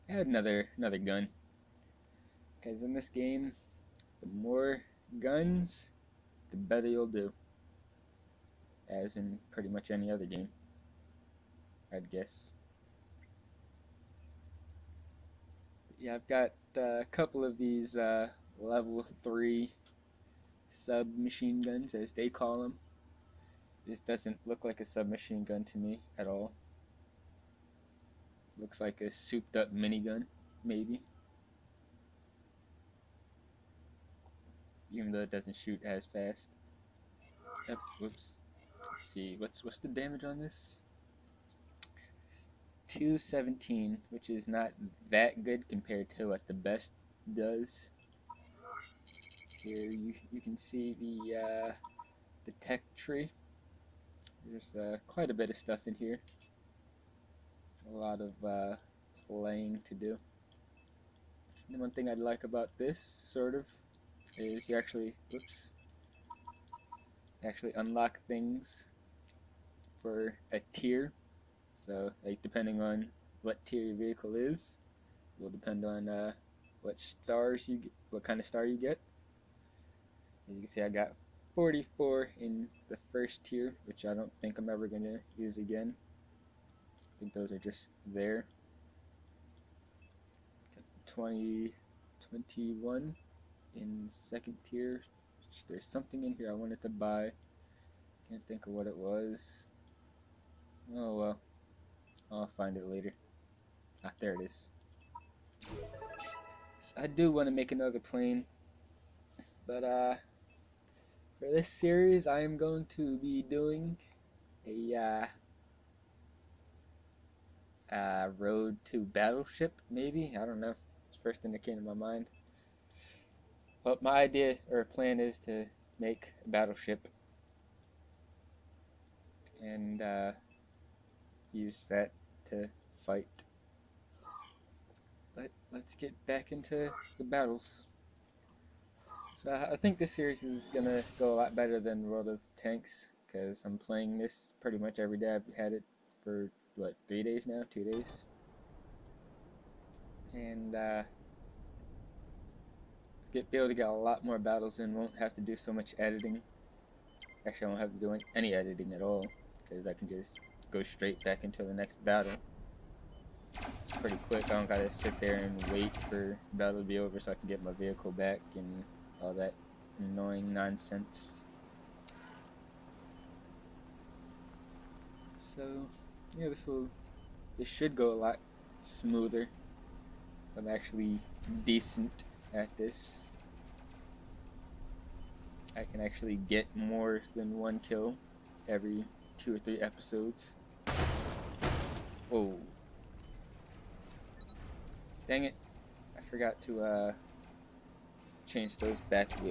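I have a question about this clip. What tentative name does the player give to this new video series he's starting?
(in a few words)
Road to Battleship.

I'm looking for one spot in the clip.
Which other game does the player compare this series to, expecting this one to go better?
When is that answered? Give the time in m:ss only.
2:22.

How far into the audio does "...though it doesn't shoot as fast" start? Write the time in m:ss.
0:35.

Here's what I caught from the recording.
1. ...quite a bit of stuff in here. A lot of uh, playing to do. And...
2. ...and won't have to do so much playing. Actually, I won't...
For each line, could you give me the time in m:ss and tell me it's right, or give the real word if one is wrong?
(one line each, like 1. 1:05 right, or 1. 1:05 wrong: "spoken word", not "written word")
1. 0:55 right
2. 2:34 wrong: "editing", not "playing".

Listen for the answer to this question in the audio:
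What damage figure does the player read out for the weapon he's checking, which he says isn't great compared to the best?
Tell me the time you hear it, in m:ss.
0:42.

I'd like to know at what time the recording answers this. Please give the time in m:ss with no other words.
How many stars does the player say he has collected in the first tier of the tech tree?
1:21.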